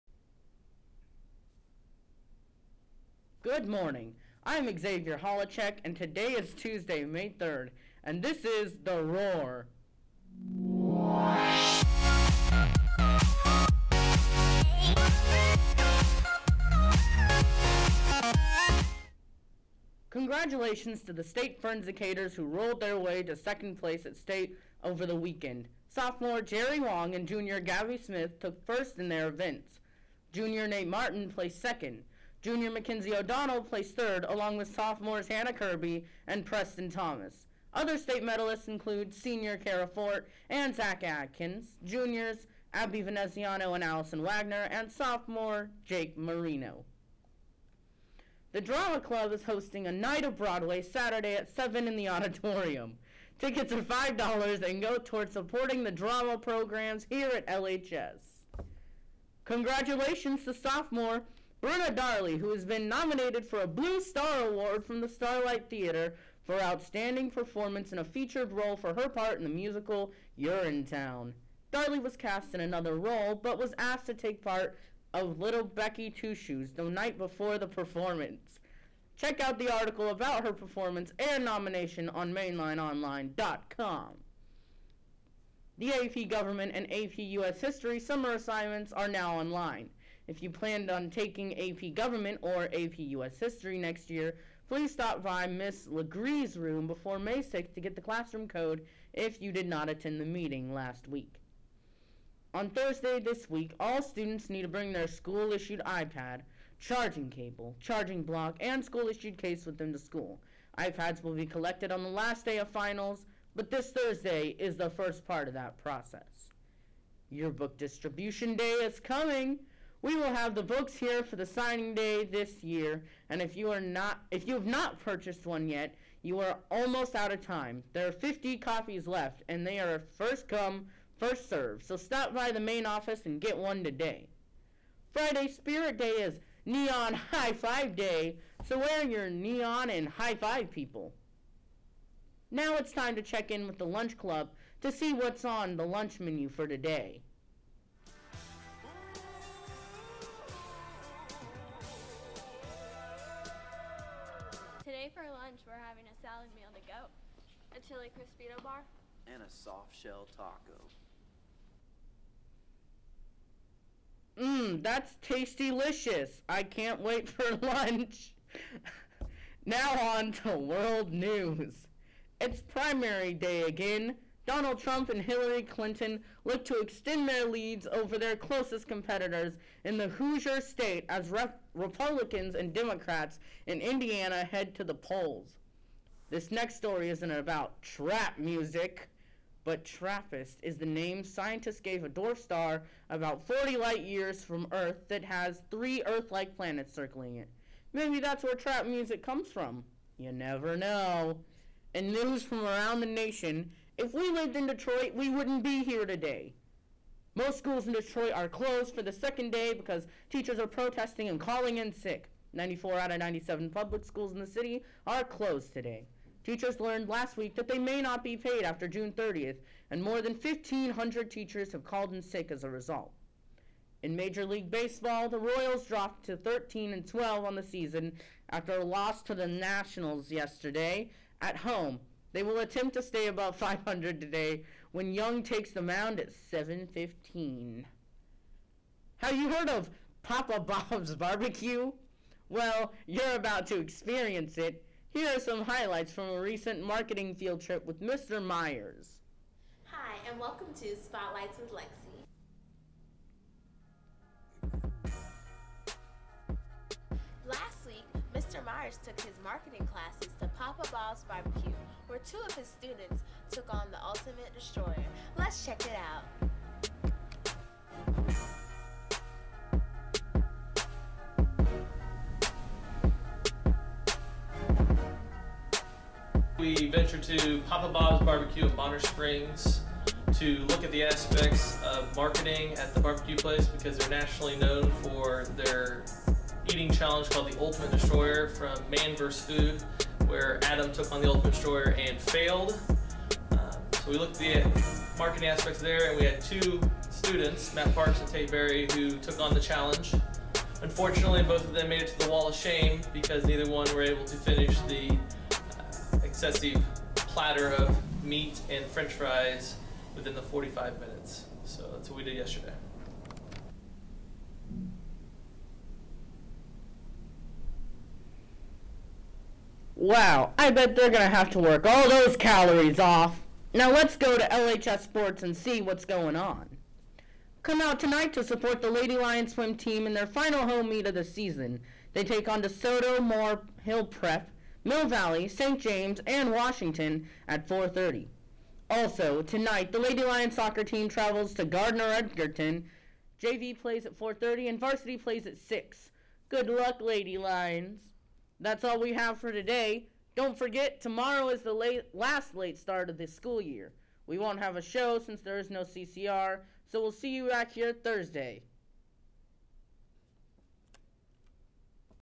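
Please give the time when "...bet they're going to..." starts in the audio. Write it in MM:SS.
05:20.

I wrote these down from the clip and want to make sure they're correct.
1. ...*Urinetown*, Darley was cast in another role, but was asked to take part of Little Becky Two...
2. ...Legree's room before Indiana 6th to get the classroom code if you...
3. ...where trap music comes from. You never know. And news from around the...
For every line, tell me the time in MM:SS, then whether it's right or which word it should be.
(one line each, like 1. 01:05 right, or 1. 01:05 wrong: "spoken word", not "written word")
1. 01:10 right
2. 01:35 wrong: "May", not "Indiana"
3. 03:18 right.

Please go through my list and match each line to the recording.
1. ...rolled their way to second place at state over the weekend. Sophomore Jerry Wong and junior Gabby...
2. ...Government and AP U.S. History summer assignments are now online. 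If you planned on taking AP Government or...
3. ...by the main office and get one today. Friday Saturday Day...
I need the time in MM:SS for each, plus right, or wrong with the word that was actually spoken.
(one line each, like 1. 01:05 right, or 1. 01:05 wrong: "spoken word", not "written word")
1. 00:22 right
2. 01:26 right
3. 02:12 wrong: "Spirit", not "Saturday".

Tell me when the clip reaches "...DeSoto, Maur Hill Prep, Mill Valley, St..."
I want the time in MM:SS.
05:32.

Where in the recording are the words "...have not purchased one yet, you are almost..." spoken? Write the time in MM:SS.
02:04.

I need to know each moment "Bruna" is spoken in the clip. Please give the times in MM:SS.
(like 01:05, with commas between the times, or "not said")
01:01.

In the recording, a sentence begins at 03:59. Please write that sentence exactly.
Have you heard of Papa Bob's barbecue?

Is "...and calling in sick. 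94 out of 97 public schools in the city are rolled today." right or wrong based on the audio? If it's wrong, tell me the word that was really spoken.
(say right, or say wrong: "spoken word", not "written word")
wrong: "closed", not "rolled".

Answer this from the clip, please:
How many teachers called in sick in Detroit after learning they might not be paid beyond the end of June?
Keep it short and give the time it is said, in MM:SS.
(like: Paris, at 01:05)
1,500, at 03:40.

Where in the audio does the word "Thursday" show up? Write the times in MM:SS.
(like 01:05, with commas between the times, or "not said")
01:42, 01:53, 05:57.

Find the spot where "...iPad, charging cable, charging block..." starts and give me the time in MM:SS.
01:45.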